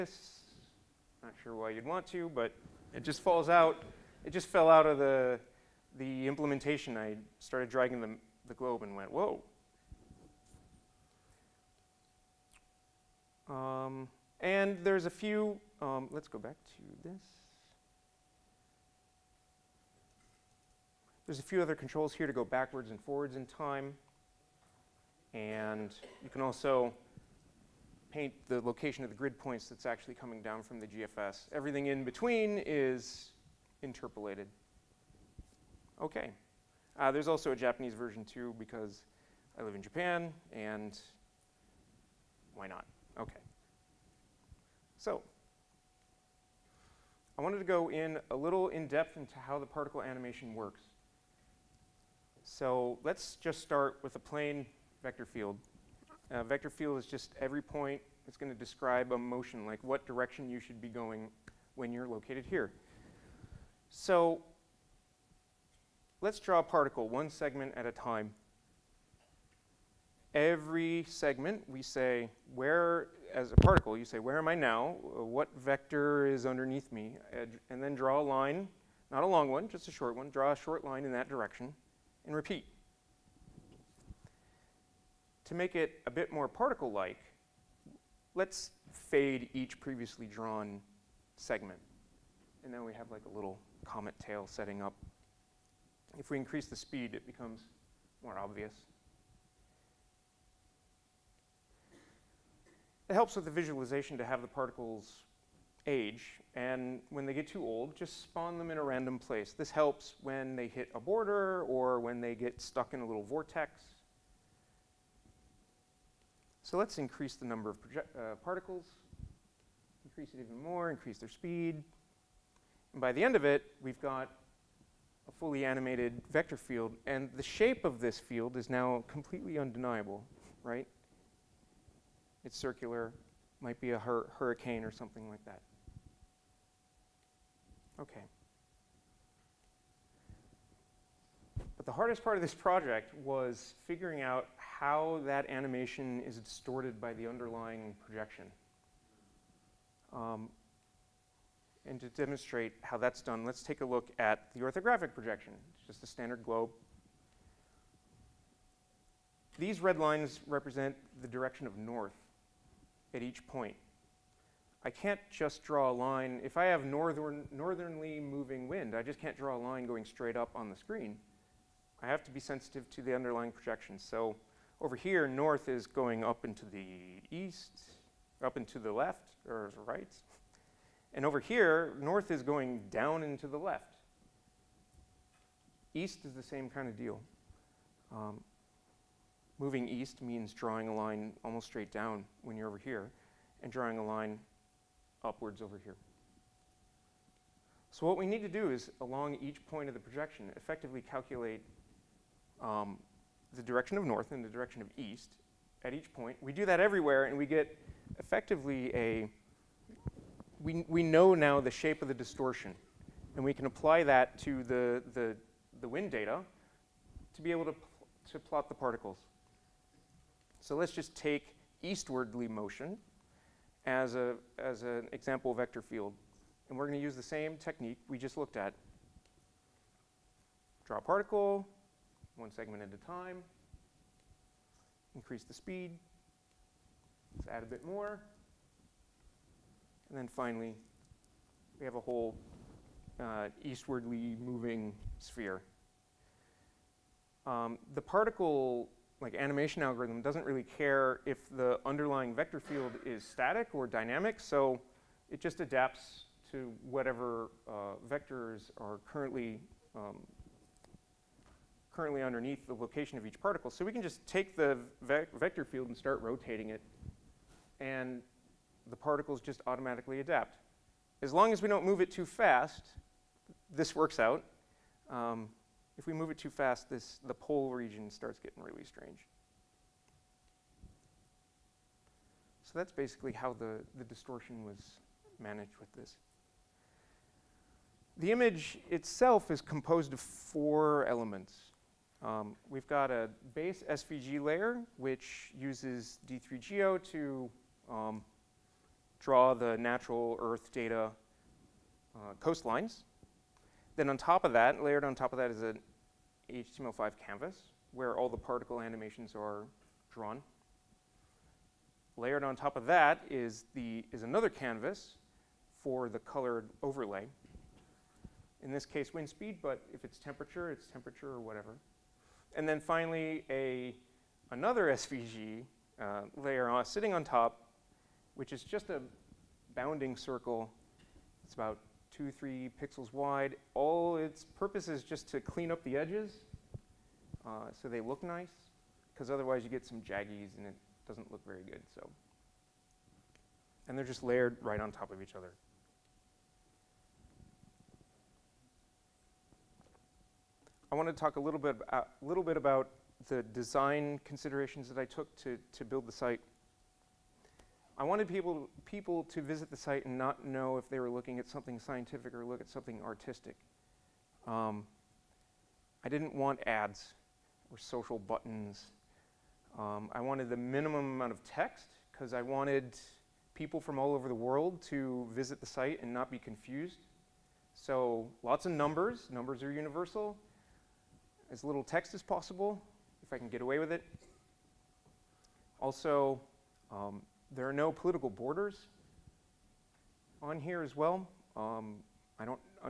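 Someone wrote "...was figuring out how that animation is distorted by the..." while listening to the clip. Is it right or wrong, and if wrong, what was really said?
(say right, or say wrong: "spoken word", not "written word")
right.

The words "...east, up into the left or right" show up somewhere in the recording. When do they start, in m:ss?
2:57.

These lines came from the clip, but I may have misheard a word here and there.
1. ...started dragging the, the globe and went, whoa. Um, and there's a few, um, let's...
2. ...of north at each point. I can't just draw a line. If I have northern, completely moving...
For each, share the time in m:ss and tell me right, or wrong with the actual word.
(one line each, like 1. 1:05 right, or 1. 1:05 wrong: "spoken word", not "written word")
1. 0:07 right
2. 2:41 wrong: "northernly", not "completely".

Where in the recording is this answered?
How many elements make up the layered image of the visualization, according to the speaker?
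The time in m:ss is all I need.
4:50.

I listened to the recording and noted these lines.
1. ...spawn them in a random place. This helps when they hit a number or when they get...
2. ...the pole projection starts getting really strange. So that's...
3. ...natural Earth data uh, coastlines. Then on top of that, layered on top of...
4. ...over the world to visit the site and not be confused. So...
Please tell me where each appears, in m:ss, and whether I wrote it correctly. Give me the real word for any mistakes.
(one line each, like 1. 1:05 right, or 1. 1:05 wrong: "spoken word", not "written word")
1. 1:48 wrong: "border", not "number"
2. 4:37 wrong: "region", not "projection"
3. 4:59 right
4. 6:14 right.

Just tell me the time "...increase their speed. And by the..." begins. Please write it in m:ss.
2:00.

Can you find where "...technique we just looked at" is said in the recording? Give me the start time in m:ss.
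3:47.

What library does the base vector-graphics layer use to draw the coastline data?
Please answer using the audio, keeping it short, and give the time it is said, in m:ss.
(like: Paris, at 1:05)
D3GEO, at 4:56.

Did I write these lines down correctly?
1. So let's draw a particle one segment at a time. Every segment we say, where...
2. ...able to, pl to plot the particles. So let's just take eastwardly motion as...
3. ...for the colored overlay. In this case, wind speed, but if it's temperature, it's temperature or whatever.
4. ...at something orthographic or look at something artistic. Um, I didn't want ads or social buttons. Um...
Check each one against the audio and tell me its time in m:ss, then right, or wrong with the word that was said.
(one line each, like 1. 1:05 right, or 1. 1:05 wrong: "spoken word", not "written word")
1. 1:03 right
2. 3:37 right
3. 5:15 right
4. 6:01 wrong: "scientific", not "orthographic".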